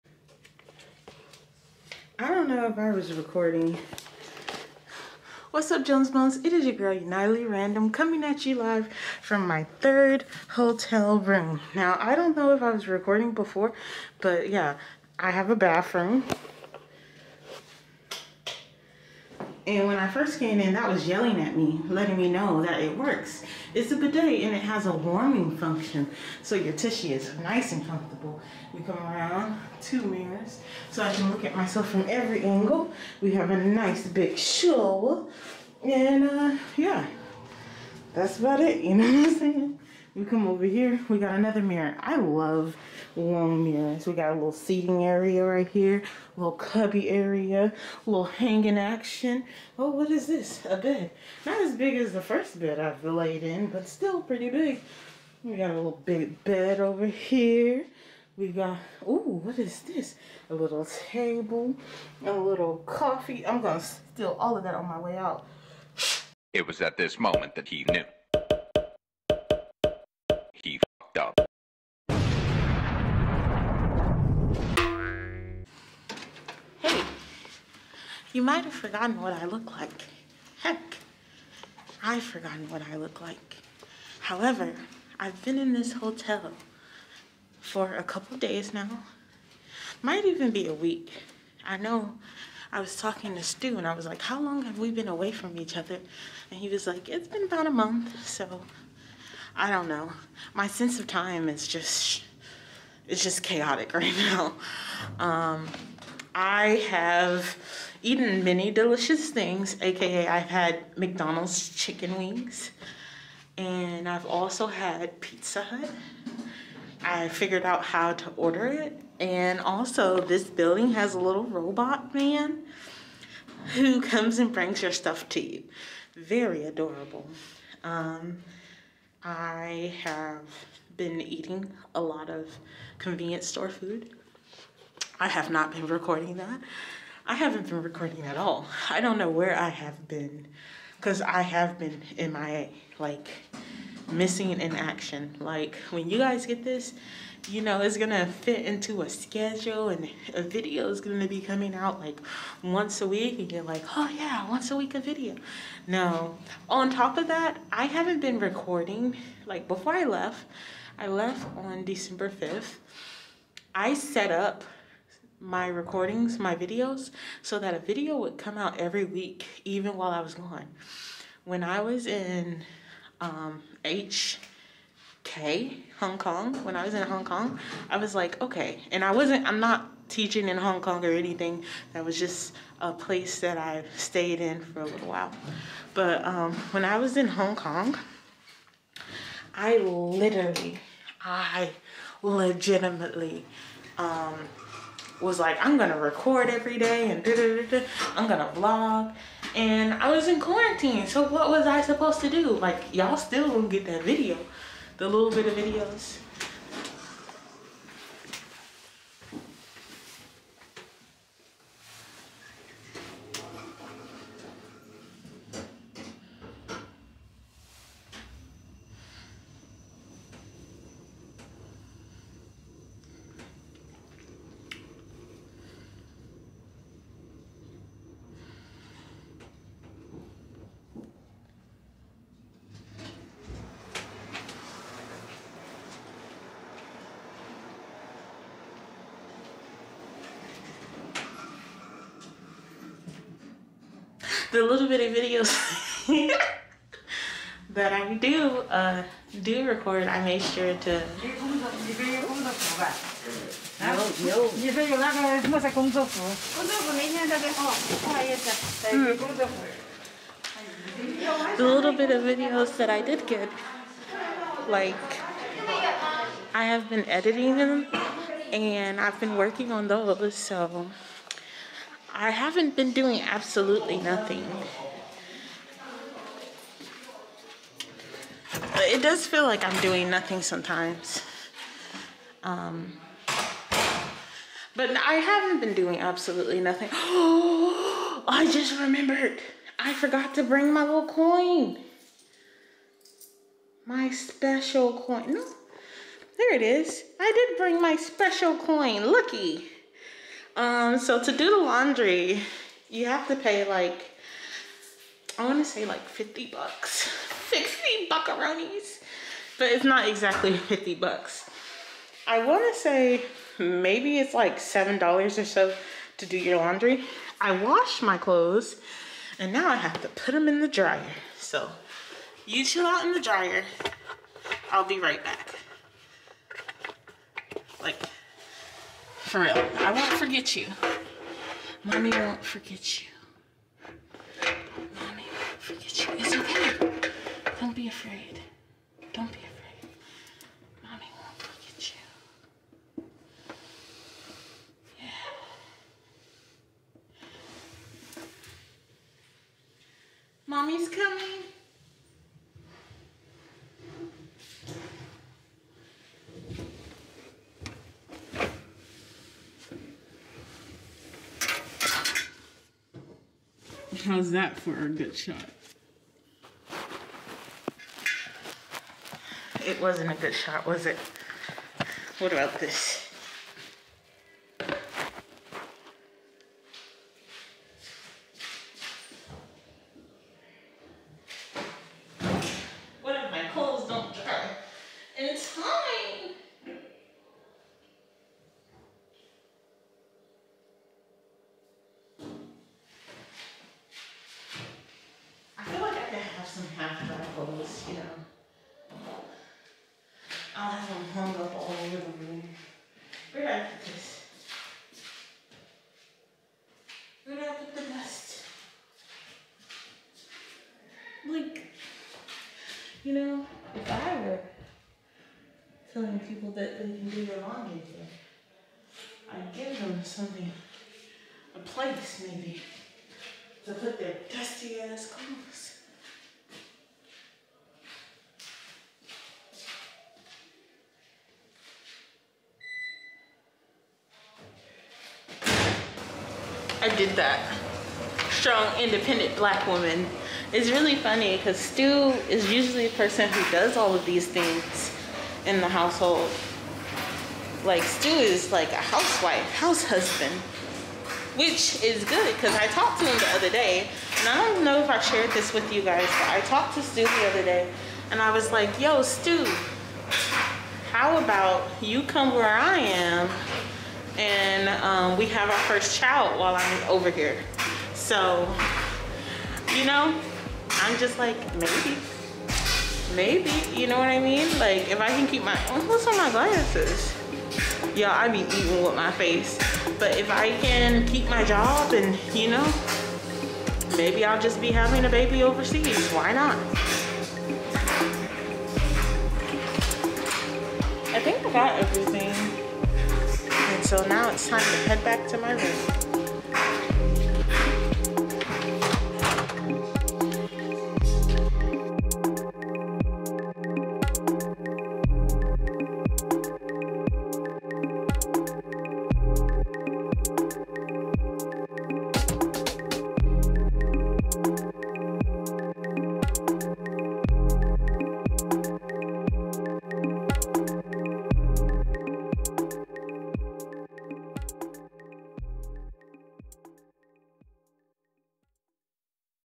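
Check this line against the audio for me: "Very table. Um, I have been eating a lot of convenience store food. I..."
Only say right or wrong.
wrong.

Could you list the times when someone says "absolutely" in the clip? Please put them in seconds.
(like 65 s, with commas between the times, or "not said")
273 s, 285 s.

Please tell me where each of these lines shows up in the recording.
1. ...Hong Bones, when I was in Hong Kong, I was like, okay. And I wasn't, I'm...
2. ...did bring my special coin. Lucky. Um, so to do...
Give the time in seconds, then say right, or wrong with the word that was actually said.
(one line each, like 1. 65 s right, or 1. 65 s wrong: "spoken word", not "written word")
1. 175 s wrong: "Kong", not "Bones"
2. 297 s right.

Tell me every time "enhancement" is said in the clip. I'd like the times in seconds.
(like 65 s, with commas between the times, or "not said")
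not said.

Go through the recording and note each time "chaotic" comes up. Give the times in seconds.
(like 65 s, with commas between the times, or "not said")
103 s.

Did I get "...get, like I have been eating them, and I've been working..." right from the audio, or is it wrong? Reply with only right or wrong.
wrong.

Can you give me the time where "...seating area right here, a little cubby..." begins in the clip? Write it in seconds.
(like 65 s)
44 s.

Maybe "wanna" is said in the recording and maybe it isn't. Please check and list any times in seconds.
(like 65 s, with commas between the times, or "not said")
305 s, 312 s.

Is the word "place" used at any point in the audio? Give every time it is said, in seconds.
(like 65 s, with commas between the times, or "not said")
182 s, 421 s.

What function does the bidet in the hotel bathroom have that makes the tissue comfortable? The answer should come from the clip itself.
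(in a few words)
warming function.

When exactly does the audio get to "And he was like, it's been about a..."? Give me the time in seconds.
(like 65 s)
96 s.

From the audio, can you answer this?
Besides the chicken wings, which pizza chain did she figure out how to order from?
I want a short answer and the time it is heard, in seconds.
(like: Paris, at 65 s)
Pizza Hut, at 115 s.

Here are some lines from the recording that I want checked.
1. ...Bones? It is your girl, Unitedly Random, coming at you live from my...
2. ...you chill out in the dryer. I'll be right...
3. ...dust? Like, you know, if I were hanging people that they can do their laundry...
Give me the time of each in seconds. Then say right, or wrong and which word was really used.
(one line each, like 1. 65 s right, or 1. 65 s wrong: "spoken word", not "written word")
1. 6 s right
2. 322 s right
3. 407 s wrong: "telling", not "hanging".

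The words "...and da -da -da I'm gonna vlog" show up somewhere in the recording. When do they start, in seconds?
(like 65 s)
197 s.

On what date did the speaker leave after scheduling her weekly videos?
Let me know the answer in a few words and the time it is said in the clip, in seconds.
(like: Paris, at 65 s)
December 5th, at 161 s.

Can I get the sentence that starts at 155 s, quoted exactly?
No, on top of that, I haven't been recording.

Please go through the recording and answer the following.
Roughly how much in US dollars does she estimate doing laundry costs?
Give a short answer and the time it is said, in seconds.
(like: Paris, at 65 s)
$7, at 314 s.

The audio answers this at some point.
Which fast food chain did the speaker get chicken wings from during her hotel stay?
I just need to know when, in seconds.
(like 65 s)
110 s.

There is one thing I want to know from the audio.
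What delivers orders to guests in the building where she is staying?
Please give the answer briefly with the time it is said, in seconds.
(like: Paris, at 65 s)
a little robot man, at 121 s.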